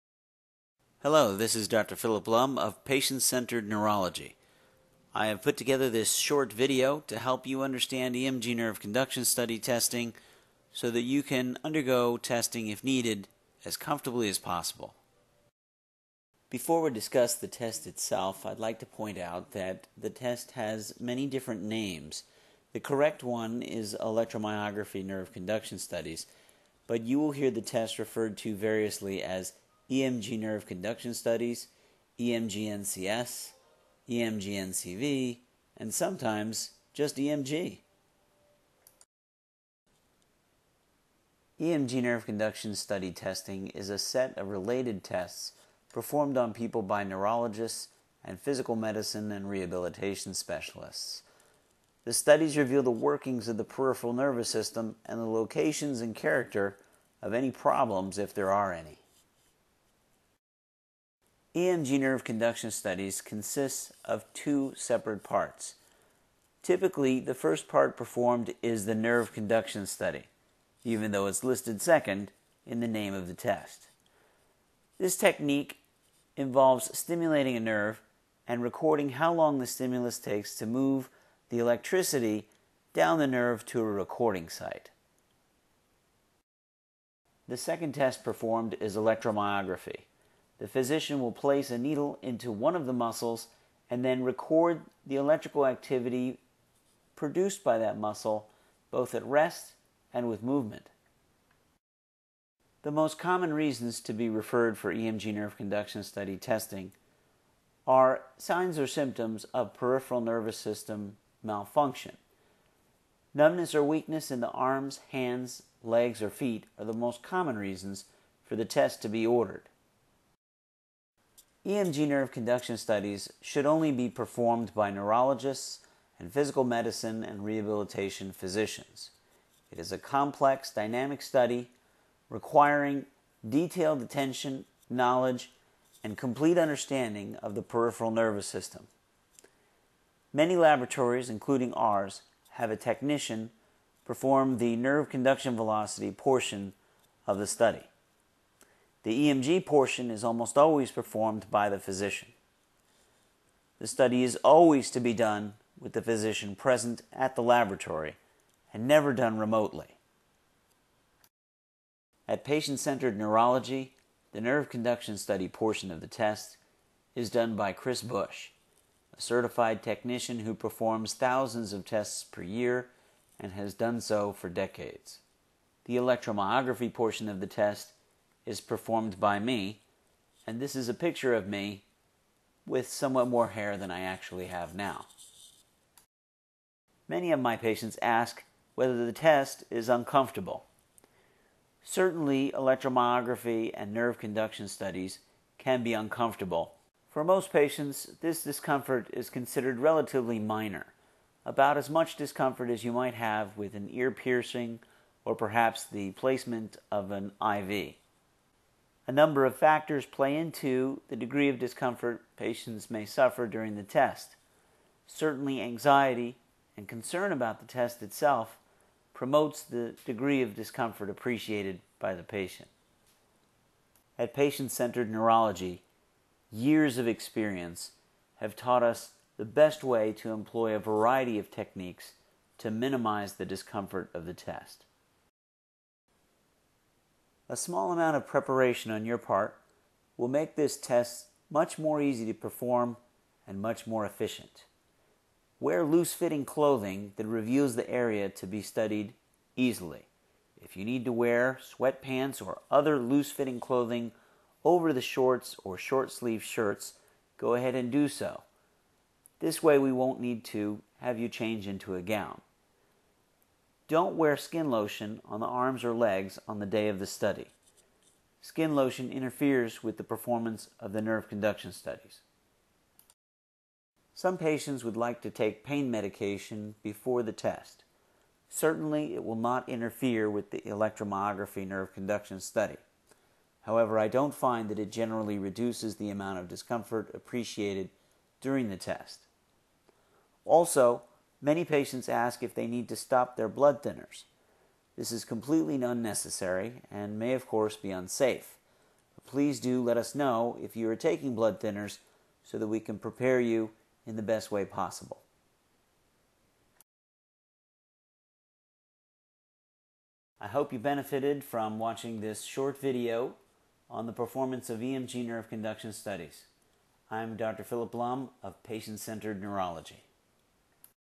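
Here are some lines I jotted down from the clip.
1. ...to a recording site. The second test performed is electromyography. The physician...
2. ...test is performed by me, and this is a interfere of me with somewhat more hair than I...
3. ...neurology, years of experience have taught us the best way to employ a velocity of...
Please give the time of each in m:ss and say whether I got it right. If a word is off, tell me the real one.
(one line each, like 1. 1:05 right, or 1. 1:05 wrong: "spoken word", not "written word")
1. 1:23 right
2. 2:57 wrong: "picture", not "interfere"
3. 3:45 wrong: "variety", not "velocity".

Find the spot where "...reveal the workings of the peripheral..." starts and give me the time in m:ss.
0:52.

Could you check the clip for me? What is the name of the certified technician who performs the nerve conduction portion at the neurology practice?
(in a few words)
Chris Bush.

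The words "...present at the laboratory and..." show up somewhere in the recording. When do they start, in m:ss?
2:36.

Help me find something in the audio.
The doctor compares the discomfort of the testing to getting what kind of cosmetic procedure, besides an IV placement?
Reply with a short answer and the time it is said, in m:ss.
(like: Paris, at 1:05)
Ear piercing, at 3:23.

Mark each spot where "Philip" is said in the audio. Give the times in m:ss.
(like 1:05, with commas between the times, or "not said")
0:01, 5:17.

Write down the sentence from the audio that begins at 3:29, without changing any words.
A number of factors play into the degree of discomfort patients may suffer during the test.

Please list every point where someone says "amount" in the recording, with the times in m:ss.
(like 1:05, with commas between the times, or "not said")
3:57, 4:46.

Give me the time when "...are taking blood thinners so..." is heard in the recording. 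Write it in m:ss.
5:00.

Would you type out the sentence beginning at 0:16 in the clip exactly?
Before we discuss the test itself, I'd like to point out that the test has many different names.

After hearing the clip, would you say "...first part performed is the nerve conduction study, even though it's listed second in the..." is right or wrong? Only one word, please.
right.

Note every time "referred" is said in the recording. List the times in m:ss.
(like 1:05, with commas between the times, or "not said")
0:27, 1:44.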